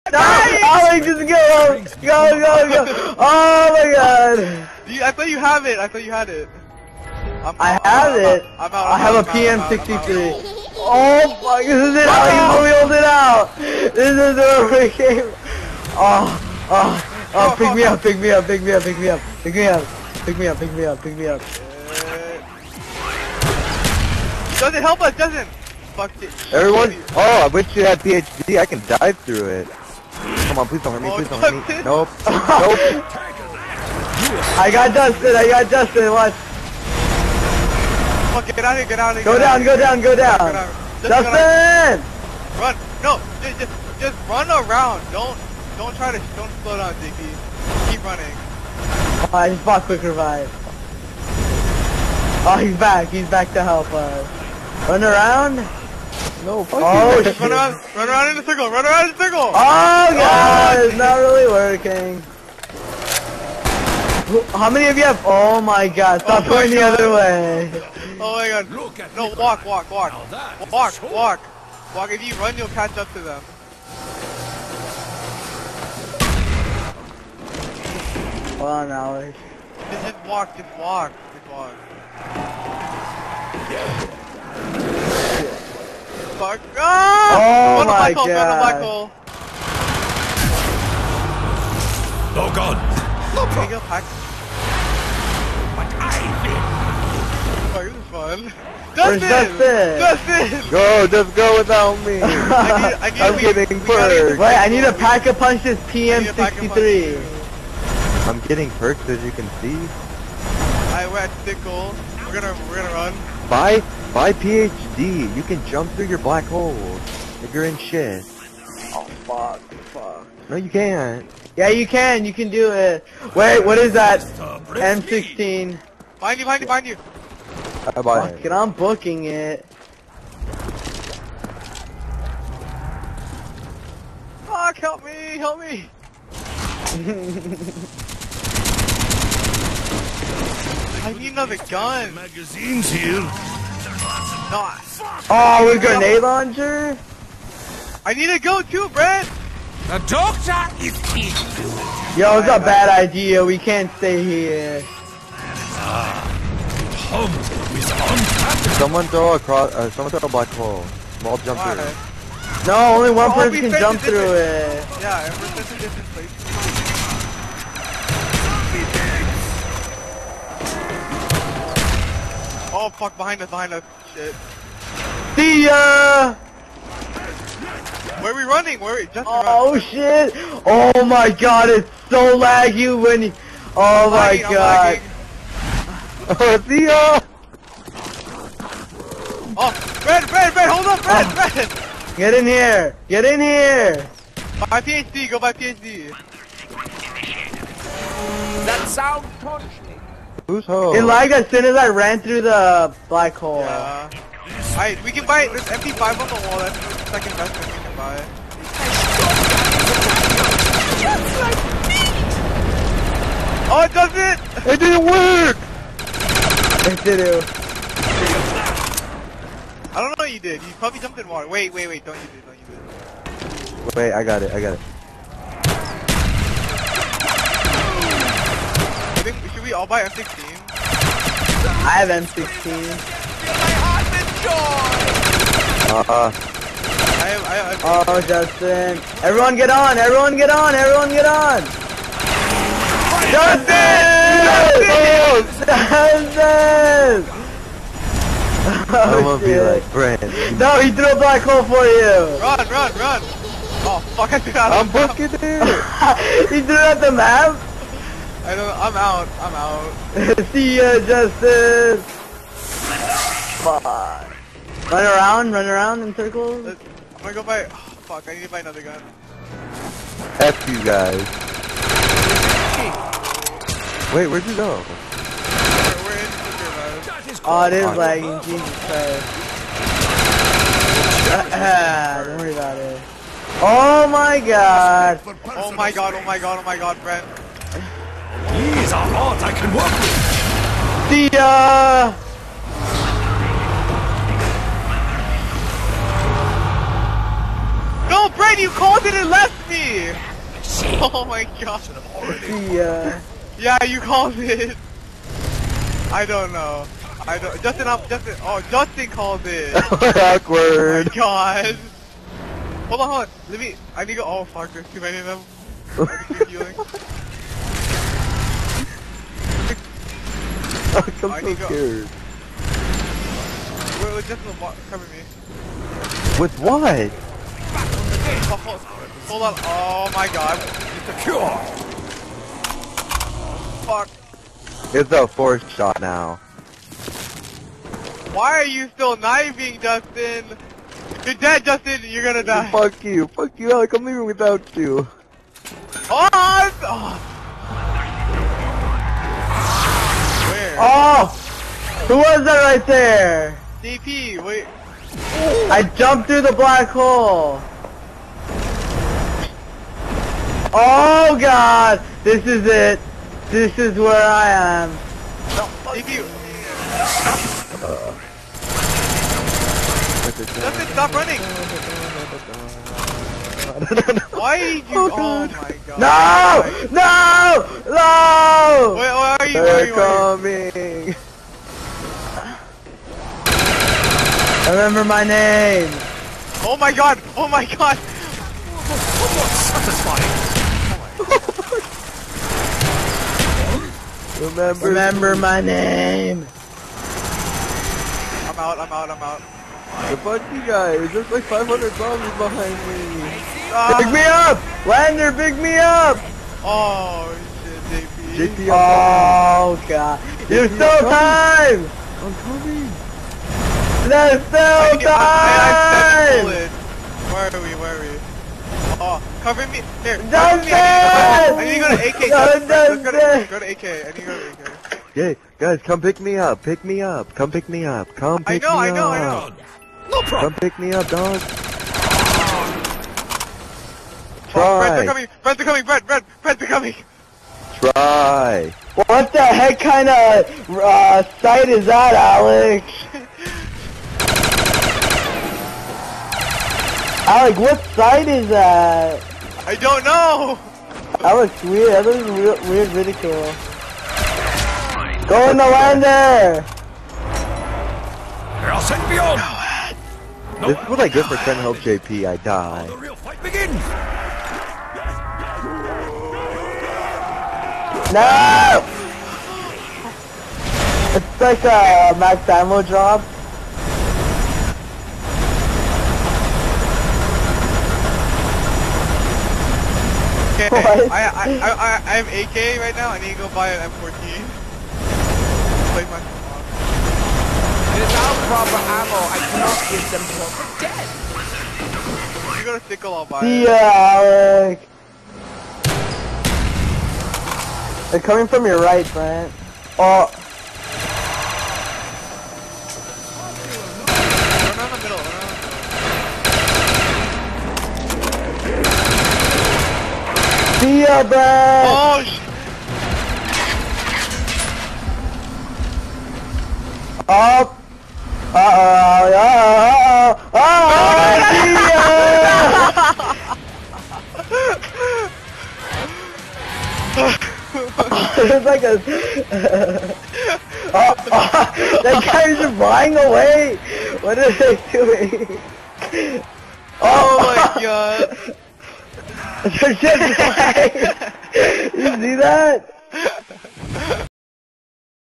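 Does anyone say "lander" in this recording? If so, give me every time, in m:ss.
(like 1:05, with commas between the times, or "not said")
6:44, 7:35.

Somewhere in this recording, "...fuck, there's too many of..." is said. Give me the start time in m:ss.
5:14.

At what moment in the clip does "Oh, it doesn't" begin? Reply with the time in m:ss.
3:33.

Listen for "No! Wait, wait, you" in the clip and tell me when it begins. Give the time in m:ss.
6:17.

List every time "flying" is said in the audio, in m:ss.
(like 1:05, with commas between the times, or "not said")
8:52, 9:00.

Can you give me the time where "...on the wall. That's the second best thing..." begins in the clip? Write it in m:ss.
3:26.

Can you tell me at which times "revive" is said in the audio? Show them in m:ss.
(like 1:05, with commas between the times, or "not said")
0:50.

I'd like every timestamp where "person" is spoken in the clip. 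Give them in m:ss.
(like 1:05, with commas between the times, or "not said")
2:43.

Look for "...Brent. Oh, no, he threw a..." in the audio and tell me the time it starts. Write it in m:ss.
4:09.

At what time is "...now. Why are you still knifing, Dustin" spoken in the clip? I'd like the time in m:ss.
5:36.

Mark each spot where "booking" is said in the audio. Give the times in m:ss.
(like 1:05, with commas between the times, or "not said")
2:08, 4:14.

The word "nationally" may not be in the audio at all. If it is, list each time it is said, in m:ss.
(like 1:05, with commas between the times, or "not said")
not said.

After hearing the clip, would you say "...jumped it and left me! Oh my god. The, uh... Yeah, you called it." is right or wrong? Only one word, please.
wrong.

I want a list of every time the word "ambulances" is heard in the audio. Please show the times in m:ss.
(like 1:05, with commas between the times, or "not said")
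not said.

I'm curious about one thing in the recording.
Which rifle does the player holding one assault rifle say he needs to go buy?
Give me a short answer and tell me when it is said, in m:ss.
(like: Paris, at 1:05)
M14, at 8:03.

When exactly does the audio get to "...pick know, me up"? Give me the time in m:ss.
7:08.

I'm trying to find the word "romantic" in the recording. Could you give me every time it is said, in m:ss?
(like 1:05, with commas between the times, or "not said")
not said.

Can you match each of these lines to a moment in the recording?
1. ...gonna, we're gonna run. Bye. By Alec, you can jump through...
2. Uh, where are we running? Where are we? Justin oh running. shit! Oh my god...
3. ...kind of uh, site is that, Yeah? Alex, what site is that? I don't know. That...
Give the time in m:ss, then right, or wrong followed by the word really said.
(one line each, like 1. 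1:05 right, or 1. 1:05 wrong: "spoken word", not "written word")
1. 1:52 wrong: "PhD", not "Alec"
2. 2:55 right
3. 7:19 wrong: "Alex", not "Yeah".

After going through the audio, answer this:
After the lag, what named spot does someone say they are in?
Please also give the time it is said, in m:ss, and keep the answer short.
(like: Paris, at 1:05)
Superman, at 4:34.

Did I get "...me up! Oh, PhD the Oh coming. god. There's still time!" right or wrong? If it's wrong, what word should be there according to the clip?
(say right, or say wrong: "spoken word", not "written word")
wrong: "Get", not "PhD".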